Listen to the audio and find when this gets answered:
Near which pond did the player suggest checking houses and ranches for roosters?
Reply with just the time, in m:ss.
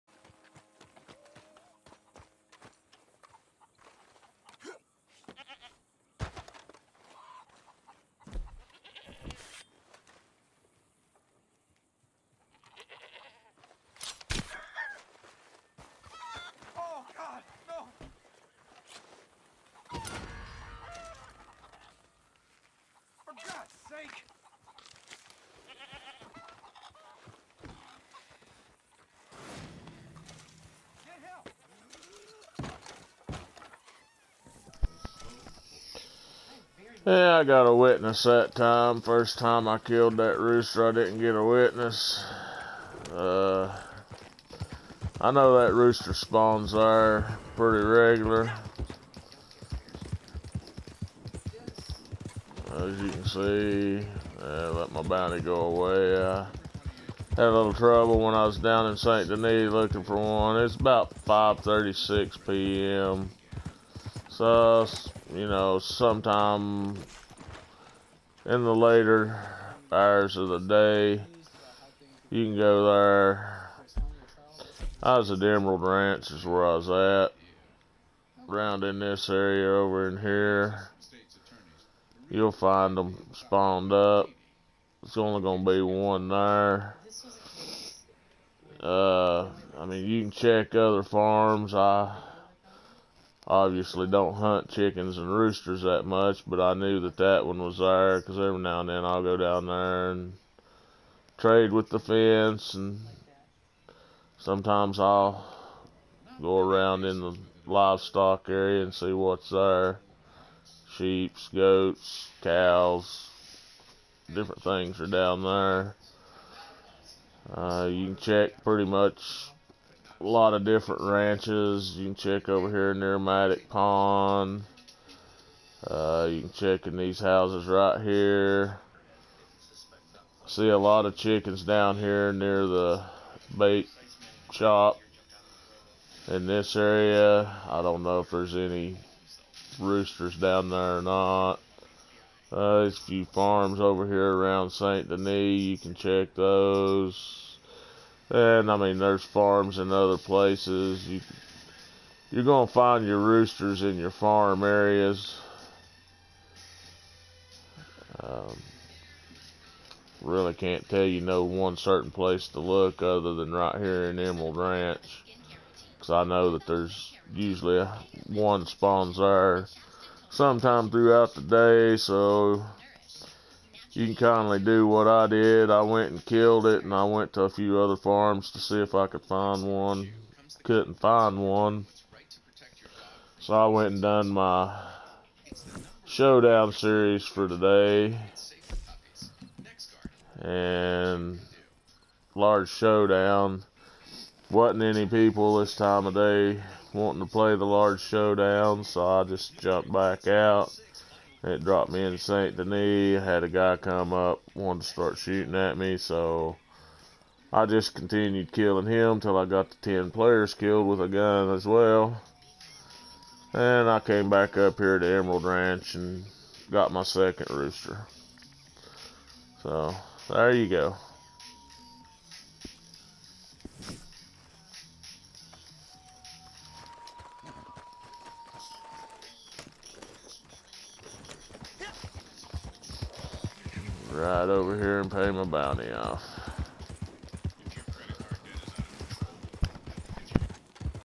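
2:03.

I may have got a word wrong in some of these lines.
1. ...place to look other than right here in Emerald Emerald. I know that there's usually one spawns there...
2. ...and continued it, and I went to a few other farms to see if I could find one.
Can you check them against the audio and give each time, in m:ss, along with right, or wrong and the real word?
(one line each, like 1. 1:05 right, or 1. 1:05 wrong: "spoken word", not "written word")
1. 2:42 wrong: "Ranch", not "Emerald"
2. 2:56 wrong: "killed", not "continued".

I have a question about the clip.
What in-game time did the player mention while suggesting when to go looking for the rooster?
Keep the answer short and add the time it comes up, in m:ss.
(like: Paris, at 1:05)
5:36 p.m., at 1:01.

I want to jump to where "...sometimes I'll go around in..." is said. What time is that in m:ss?
1:44.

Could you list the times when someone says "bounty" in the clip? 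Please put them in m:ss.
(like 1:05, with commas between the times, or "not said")
0:55, 3:55.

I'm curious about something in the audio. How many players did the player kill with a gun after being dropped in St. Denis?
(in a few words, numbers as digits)
10.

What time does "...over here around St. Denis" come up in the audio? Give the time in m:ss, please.
2:23.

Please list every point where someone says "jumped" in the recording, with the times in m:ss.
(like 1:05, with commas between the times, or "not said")
3:19.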